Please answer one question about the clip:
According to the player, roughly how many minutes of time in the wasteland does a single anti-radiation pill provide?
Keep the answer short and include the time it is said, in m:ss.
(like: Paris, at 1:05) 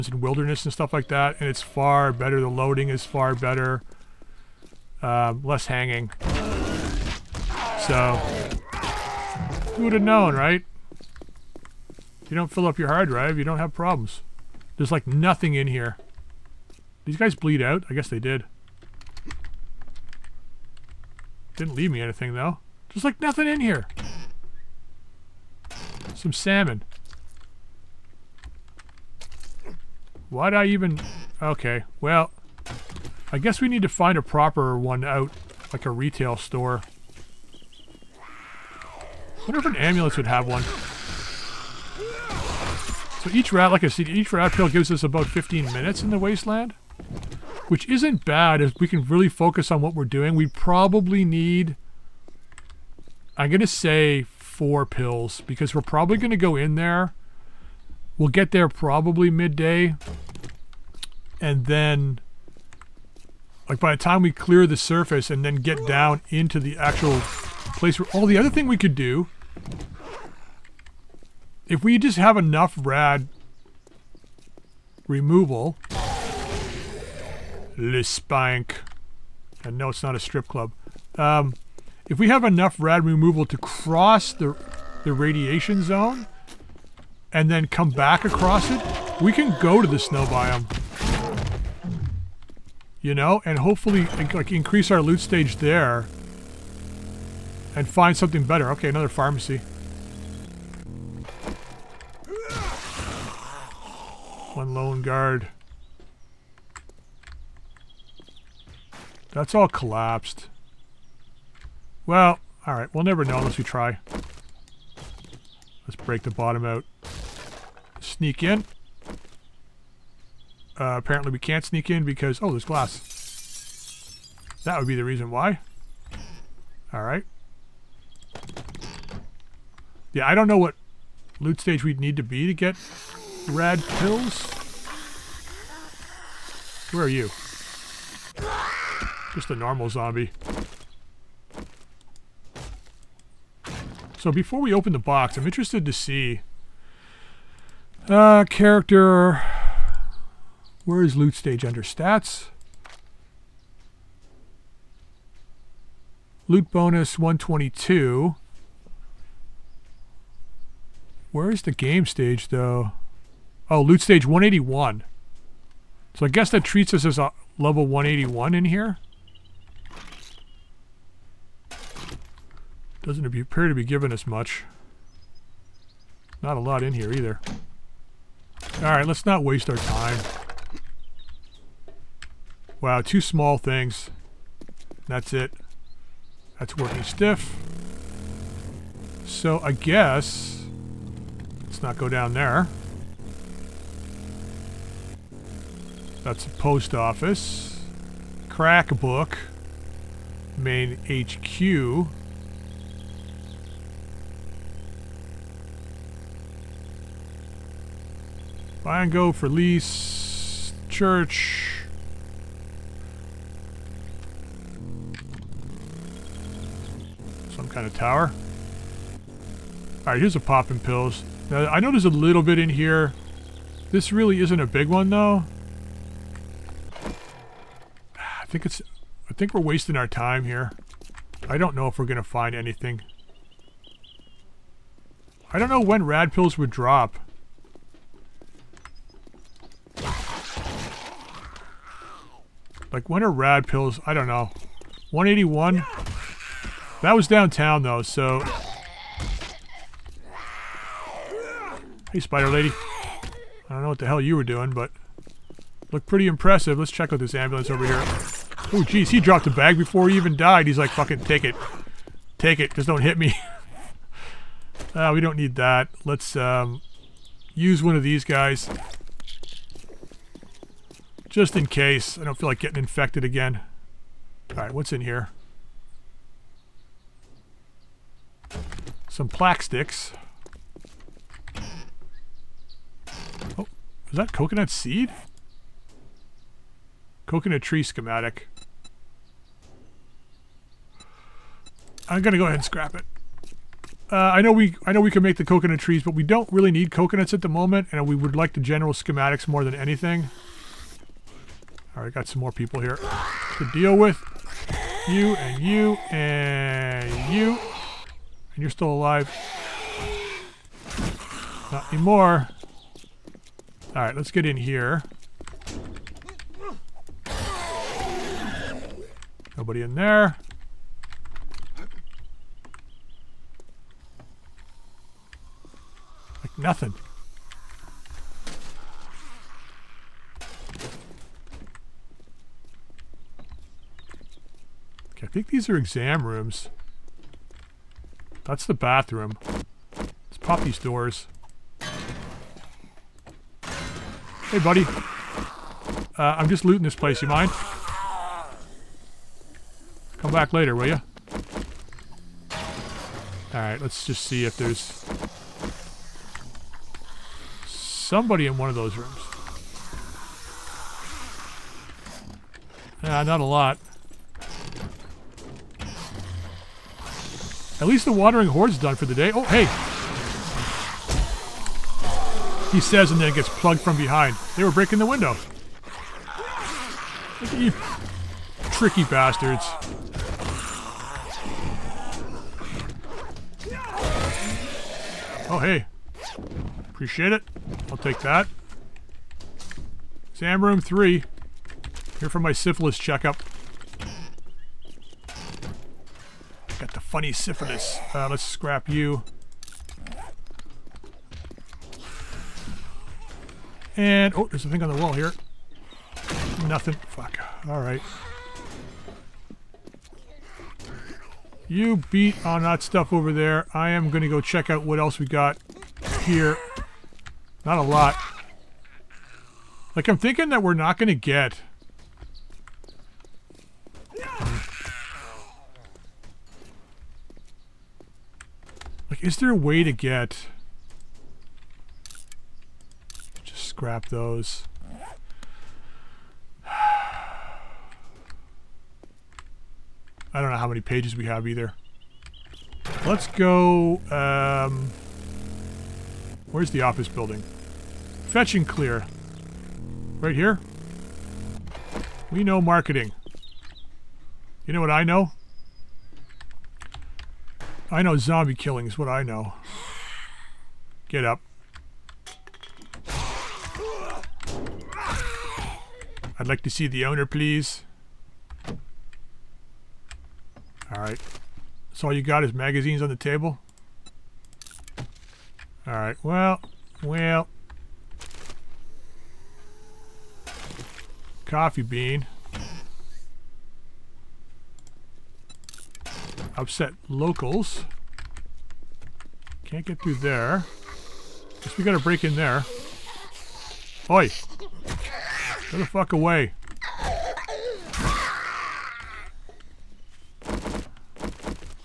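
15 minutes, at 0:45.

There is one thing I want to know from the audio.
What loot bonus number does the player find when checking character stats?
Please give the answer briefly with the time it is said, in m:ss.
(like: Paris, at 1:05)
122, at 2:36.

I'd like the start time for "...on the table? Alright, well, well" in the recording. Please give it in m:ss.
7:53.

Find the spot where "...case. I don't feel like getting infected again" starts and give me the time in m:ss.
4:31.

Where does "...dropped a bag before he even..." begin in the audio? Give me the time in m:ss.
4:19.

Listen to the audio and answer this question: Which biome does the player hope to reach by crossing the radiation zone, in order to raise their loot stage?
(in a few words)
snow biome.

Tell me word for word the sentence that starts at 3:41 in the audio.
Now, I know there's a little bit in here.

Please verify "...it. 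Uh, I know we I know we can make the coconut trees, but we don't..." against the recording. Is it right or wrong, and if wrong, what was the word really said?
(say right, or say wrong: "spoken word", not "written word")
right.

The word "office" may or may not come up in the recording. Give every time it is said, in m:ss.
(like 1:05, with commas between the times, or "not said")
3:16, 7:26.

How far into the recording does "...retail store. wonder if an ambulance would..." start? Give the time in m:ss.
0:35.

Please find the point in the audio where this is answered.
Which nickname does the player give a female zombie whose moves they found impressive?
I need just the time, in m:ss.
4:12.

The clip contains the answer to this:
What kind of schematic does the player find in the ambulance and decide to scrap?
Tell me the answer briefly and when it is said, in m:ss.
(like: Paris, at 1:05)
Coconut tree schematic, at 4:47.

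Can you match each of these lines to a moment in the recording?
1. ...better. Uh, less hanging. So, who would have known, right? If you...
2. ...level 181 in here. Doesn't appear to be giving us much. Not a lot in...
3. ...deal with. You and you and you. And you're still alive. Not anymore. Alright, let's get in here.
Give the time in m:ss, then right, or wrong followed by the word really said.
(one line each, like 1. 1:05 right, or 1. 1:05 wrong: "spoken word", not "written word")
1. 0:03 right
2. 2:47 right
3. 5:03 right.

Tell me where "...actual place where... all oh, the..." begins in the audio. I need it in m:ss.
1:06.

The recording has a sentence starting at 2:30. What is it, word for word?
Where is loot stage under stats?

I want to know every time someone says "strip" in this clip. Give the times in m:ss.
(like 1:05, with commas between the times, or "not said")
1:20.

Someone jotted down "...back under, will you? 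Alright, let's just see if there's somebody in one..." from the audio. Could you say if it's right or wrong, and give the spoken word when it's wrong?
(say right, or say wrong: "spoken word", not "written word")
wrong: "later", not "under".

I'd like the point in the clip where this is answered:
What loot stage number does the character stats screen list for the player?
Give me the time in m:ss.
2:43.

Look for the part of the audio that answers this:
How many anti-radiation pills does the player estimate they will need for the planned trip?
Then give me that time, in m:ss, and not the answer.
0:54.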